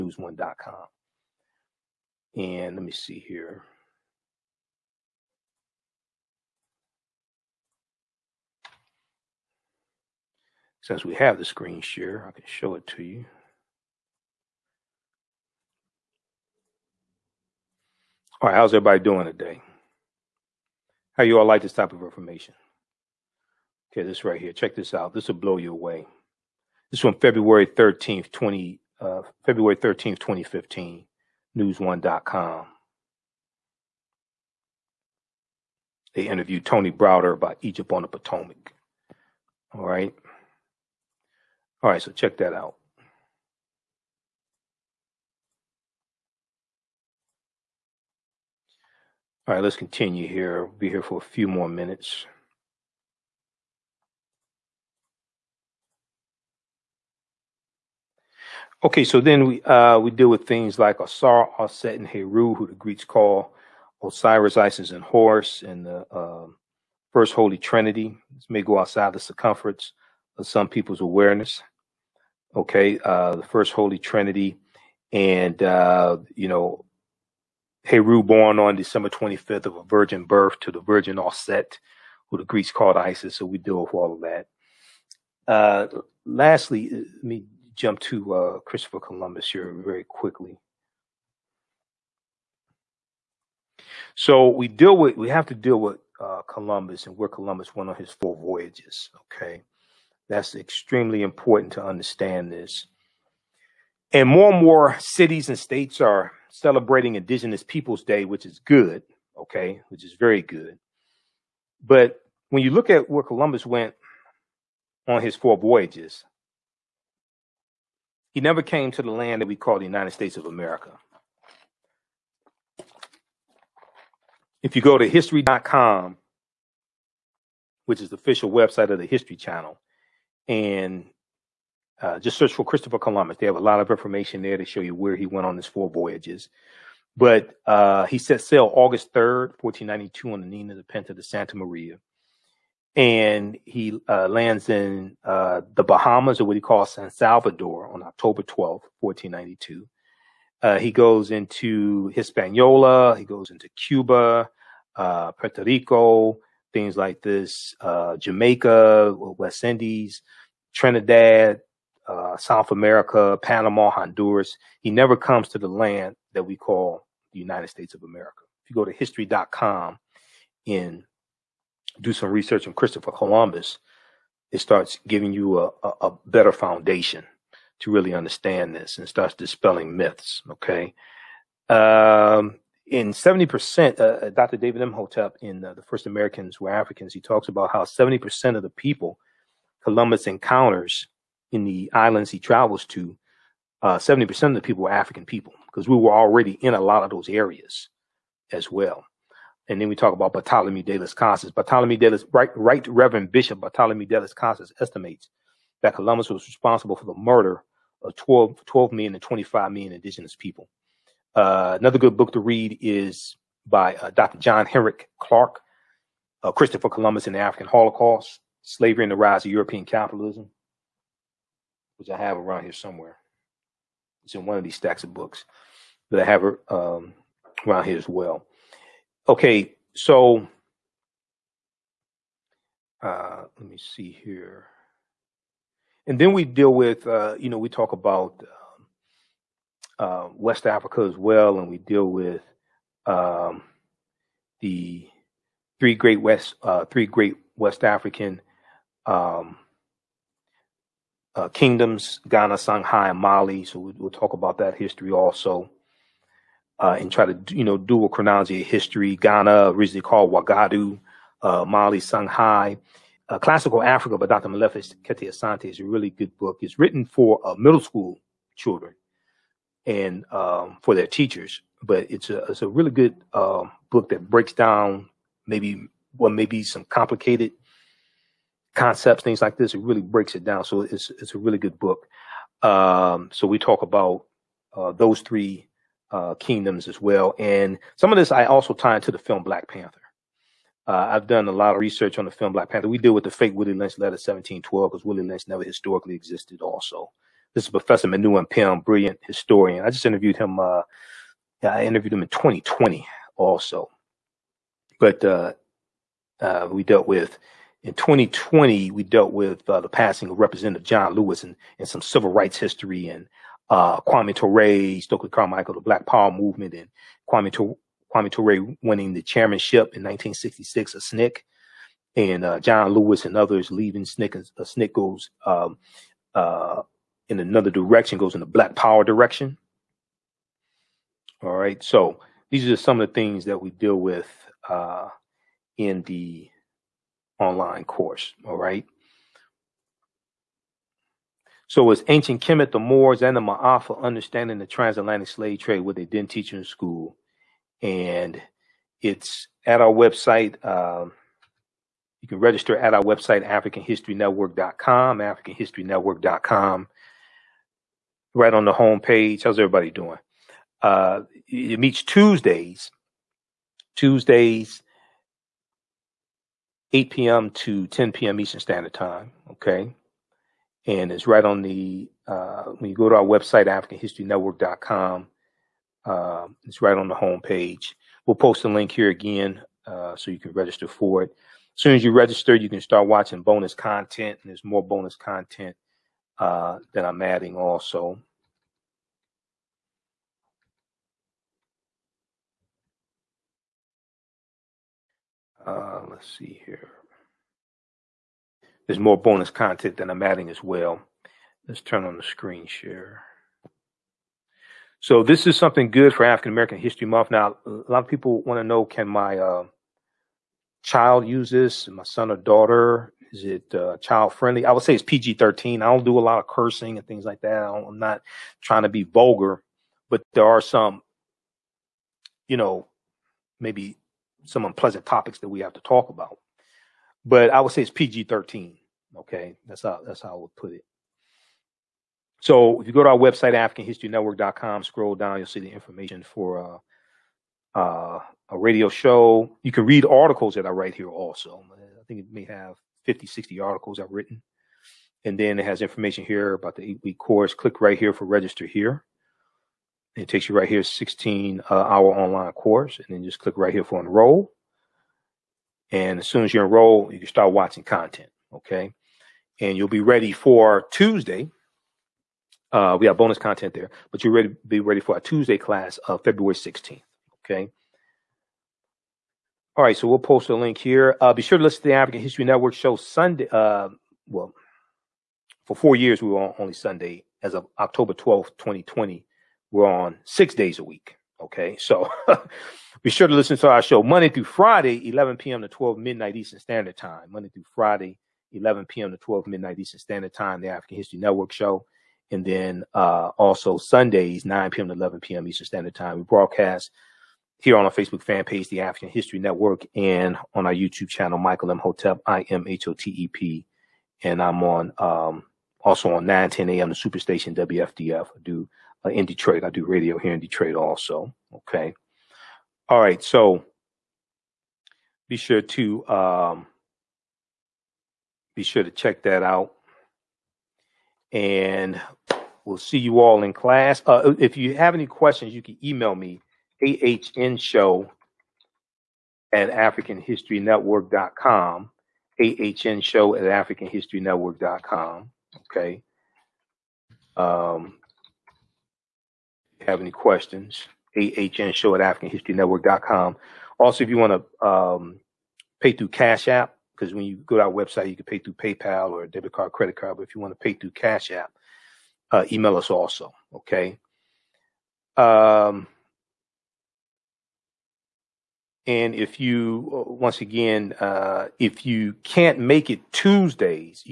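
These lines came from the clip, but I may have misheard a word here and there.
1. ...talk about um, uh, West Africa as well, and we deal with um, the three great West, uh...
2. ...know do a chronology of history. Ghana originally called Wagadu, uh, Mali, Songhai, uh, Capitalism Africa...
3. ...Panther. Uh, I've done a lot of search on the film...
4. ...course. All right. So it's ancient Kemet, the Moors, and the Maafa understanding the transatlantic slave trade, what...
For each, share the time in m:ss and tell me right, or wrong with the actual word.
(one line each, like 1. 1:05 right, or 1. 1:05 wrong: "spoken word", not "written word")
1. 3:57 right
2. 4:17 wrong: "Classical", not "Capitalism"
3. 4:49 wrong: "research", not "search"
4. 5:37 right.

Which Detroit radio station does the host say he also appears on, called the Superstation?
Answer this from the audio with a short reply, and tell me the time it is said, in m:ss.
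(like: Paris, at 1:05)
WFDF, at 8:27.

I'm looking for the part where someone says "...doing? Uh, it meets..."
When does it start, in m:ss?
5:59.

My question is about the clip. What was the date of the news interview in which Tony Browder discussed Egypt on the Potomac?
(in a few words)
February 13th, 2015.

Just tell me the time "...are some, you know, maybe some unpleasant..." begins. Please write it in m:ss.
7:00.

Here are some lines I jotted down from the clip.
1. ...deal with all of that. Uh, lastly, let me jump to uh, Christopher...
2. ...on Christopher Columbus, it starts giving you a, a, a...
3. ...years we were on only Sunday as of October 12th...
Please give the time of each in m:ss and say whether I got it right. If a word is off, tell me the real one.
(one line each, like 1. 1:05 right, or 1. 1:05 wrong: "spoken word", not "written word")
1. 1:23 right
2. 2:52 right
3. 7:55 right.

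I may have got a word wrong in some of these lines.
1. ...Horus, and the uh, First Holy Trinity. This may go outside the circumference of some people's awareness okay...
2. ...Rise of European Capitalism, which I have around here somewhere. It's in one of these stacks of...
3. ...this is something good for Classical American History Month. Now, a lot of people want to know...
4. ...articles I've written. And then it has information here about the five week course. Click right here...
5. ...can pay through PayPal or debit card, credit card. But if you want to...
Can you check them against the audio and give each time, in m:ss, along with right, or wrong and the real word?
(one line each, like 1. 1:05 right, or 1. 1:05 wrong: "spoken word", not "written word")
1. 1:05 right
2. 3:39 right
3. 6:45 wrong: "African", not "Classical"
4. 7:23 wrong: "eight", not "five"
5. 9:08 right.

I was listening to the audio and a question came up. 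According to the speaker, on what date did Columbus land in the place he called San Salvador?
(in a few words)
October 12th, 1492.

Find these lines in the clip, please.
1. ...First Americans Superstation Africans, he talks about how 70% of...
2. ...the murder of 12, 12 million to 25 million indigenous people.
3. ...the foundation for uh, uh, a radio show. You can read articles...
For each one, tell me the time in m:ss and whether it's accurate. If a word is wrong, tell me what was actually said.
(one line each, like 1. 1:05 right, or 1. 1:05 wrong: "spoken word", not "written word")
1. 3:05 wrong: "Were", not "Superstation"
2. 3:27 right
3. 7:15 wrong: "information", not "foundation".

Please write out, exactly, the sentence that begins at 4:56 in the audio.
Also, this is Professor Manu Ampim, brilliant historian.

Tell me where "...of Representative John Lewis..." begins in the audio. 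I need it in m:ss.
5:10.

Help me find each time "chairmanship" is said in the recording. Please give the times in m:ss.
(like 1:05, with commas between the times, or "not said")
5:19.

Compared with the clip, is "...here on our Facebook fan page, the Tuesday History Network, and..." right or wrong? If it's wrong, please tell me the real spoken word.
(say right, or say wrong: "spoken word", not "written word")
wrong: "African", not "Tuesday".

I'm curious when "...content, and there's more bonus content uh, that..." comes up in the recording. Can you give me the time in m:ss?
6:23.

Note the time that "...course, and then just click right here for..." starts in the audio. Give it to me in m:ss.
7:32.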